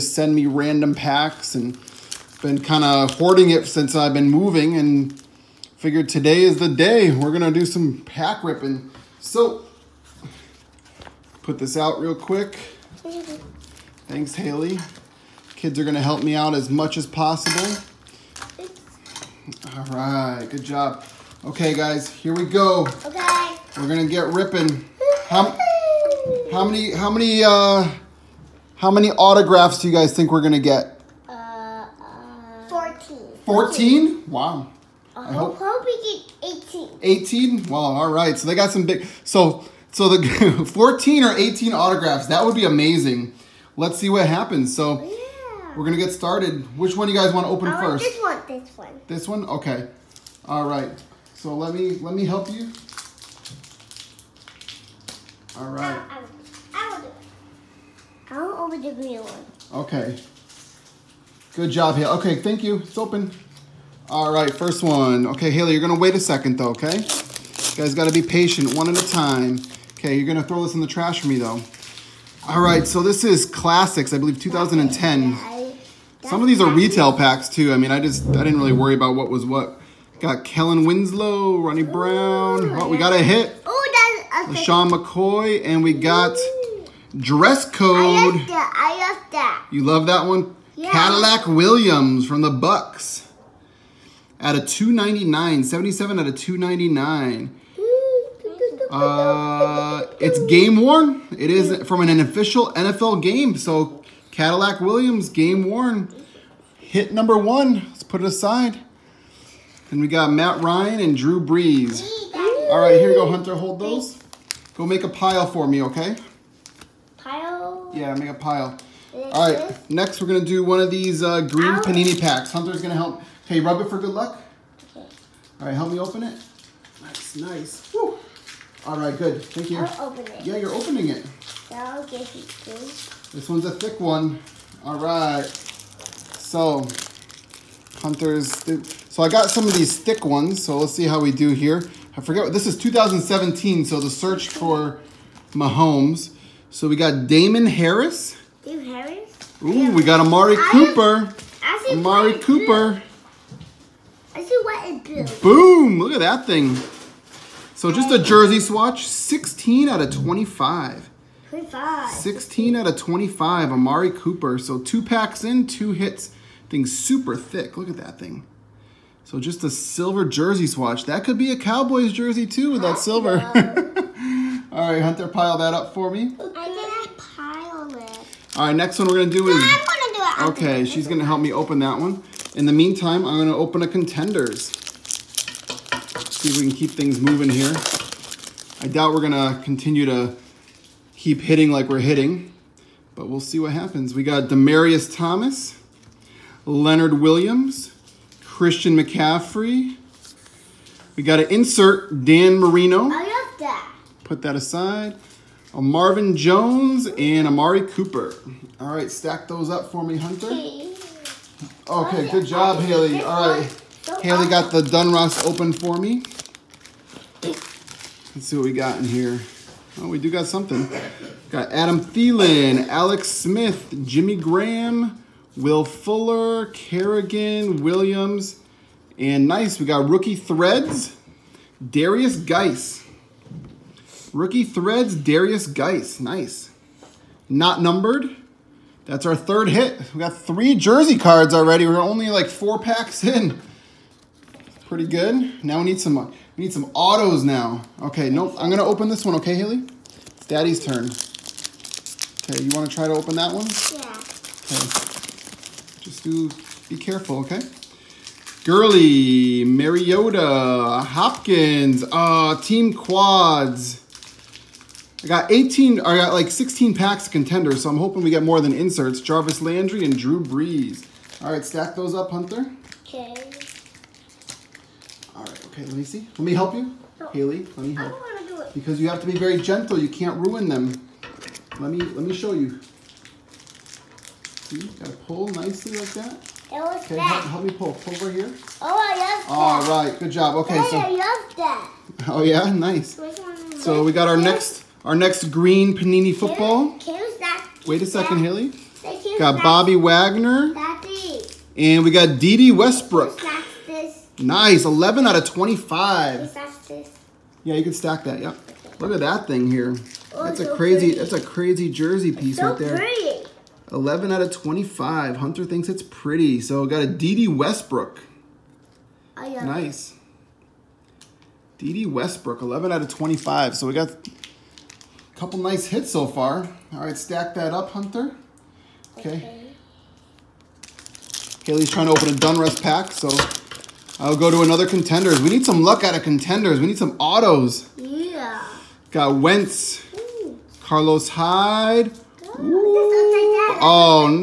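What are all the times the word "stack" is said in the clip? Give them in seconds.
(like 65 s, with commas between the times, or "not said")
209 s, 271 s, 307 s, 327 s.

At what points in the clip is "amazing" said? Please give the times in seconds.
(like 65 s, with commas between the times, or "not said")
42 s.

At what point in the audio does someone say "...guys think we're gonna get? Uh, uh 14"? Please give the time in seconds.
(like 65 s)
29 s.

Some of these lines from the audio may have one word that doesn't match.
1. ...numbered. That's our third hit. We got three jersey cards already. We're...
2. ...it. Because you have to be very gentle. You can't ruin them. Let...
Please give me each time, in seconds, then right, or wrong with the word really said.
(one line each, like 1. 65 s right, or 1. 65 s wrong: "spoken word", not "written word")
1. 237 s right
2. 278 s right.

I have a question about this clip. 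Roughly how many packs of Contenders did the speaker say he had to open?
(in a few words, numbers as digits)
16.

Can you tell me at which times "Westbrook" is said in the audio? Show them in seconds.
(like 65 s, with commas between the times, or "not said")
302 s, 317 s, 322 s.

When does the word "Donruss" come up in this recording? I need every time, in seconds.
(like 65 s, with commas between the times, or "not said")
214 s, 332 s.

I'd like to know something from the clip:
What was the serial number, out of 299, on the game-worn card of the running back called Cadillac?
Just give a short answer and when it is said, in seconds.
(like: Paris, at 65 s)
77, at 95 s.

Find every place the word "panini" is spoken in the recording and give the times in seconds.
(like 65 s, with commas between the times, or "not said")
121 s, 295 s.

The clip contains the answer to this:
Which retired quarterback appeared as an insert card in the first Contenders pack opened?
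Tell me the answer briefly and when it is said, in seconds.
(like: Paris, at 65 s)
Dan Marino, at 202 s.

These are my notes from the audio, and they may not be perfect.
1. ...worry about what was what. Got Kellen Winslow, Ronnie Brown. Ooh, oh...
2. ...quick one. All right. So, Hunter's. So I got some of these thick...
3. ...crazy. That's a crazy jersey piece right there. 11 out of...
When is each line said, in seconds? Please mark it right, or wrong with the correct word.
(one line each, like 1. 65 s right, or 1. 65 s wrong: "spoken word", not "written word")
1. 78 s right
2. 133 s wrong: "thick", not "quick"
3. 310 s right.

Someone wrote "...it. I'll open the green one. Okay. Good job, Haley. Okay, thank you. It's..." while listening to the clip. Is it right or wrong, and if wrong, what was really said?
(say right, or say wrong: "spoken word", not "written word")
right.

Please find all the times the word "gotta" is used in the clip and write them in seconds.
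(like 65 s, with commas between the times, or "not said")
67 s, 284 s.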